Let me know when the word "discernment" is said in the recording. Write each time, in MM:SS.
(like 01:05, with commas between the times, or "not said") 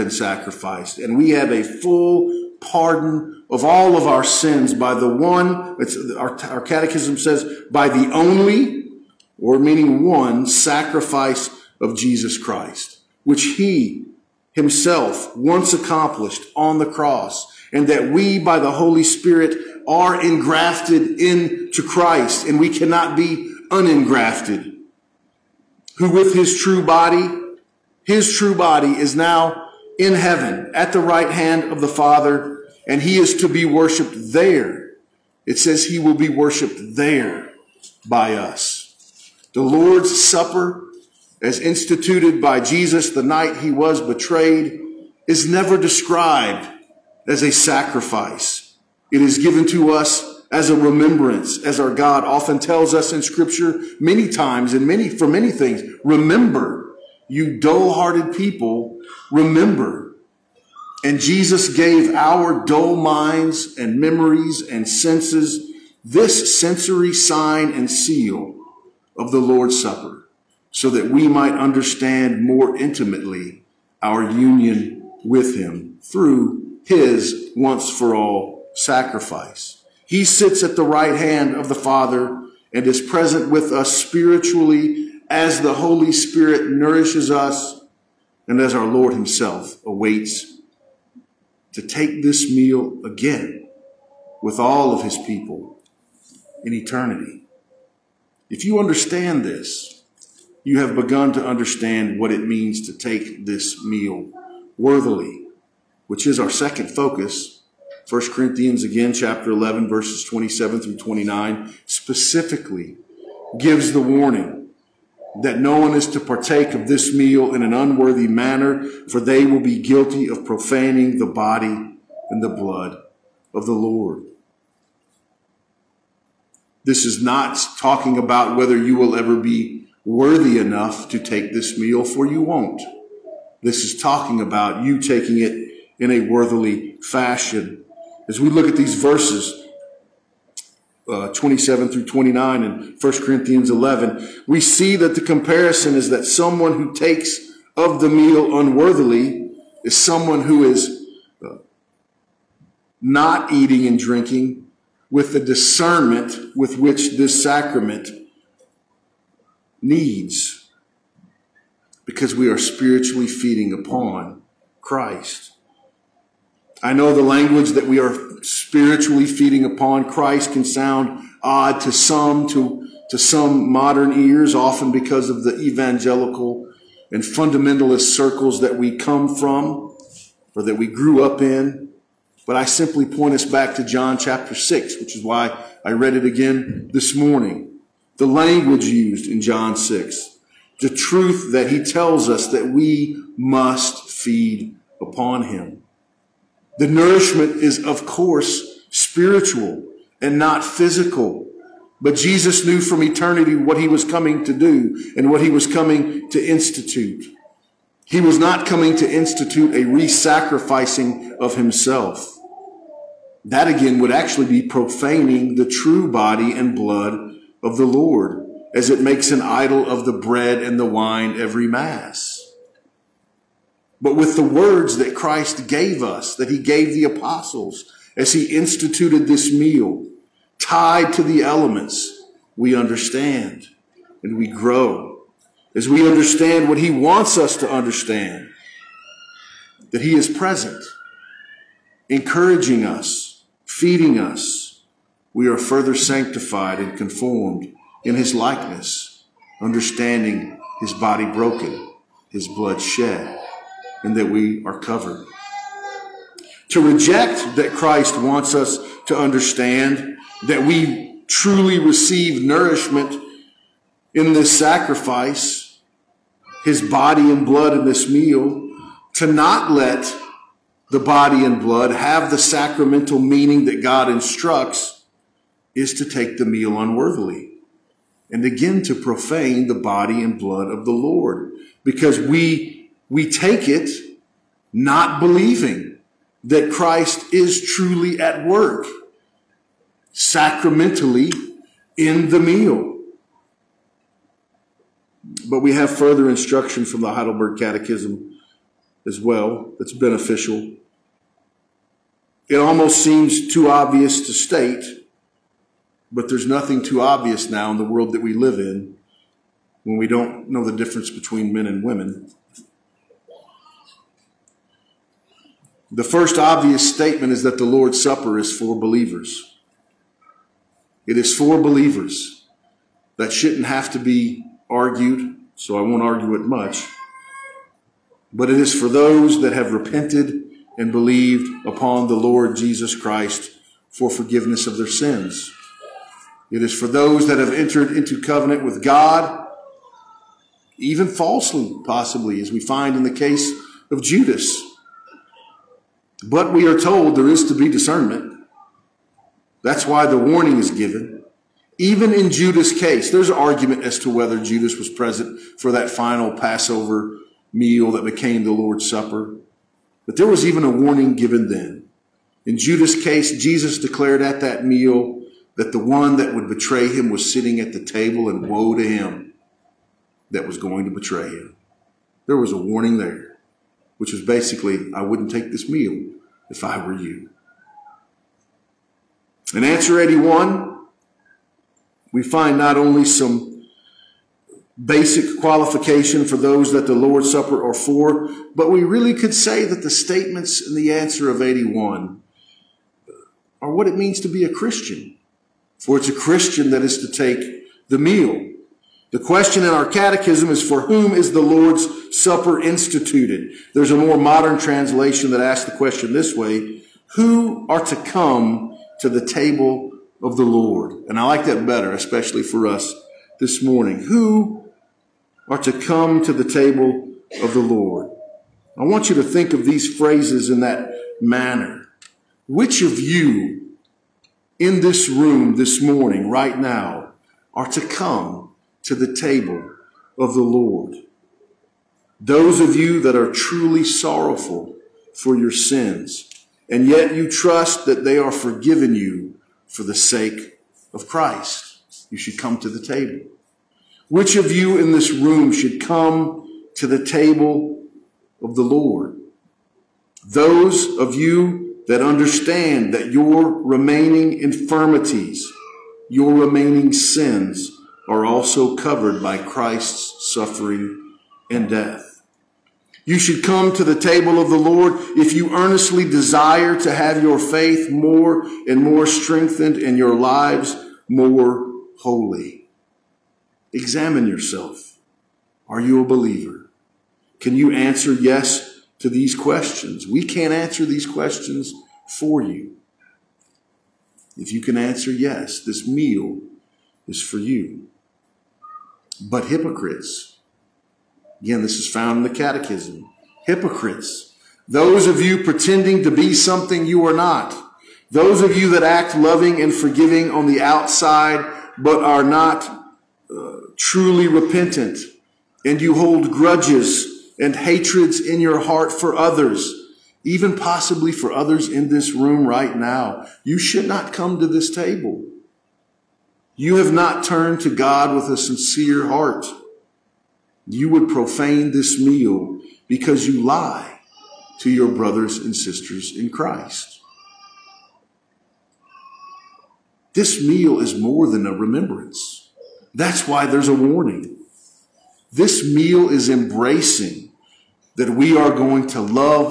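02:35, 05:47.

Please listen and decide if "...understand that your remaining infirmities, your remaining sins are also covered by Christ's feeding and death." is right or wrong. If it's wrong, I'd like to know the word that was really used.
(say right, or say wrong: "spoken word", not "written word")
wrong: "suffering", not "feeding".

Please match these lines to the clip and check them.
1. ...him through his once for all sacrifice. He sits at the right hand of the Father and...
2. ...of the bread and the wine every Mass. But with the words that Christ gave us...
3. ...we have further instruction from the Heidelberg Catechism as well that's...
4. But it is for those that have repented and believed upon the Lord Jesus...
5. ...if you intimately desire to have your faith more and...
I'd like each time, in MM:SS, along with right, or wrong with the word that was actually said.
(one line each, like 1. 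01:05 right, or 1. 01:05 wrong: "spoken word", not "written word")
1. 01:15 right
2. 03:39 right
3. 04:55 right
4. 05:28 right
5. 07:45 wrong: "earnestly", not "intimately".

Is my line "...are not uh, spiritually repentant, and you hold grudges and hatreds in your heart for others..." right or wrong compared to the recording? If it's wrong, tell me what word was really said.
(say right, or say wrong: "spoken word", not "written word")
wrong: "truly", not "spiritually".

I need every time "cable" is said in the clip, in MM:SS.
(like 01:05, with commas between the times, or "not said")
not said.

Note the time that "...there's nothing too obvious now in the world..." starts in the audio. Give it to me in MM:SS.
05:06.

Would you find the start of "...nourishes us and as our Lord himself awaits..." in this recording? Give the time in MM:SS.
01:26.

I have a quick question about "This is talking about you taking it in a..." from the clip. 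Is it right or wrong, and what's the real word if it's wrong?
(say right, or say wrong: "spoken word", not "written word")
right.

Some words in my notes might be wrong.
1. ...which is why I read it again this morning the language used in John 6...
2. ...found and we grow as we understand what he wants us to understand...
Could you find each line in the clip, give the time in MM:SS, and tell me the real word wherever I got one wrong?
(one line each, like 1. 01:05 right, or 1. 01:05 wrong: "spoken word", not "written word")
1. 03:04 right
2. 03:52 wrong: "understand", not "found".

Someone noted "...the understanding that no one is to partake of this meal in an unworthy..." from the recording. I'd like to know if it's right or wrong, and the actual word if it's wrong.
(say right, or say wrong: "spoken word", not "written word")
wrong: "warning", not "understanding".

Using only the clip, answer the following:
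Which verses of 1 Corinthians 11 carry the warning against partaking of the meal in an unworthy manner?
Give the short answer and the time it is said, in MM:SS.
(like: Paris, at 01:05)
27 through 29, at 01:49.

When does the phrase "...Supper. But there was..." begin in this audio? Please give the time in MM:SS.
05:58.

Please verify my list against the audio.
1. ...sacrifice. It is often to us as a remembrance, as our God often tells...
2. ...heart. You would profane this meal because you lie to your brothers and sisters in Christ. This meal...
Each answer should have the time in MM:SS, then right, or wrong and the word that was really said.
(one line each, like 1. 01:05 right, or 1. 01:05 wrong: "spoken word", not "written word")
1. 00:47 wrong: "given", not "often"
2. 08:39 right.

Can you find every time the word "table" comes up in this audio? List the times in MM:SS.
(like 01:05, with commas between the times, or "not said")
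06:07, 06:49, 06:56, 07:09, 07:22, 07:27, 07:43, 08:34.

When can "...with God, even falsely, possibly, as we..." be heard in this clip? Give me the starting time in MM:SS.
05:38.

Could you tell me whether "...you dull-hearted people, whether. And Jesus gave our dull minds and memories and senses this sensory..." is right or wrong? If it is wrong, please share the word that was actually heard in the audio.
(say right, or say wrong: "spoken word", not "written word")
wrong: "remember", not "whether".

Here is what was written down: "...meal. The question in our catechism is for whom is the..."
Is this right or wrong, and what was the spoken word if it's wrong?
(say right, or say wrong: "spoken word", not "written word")
right.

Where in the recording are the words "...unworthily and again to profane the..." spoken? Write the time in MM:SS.
04:36.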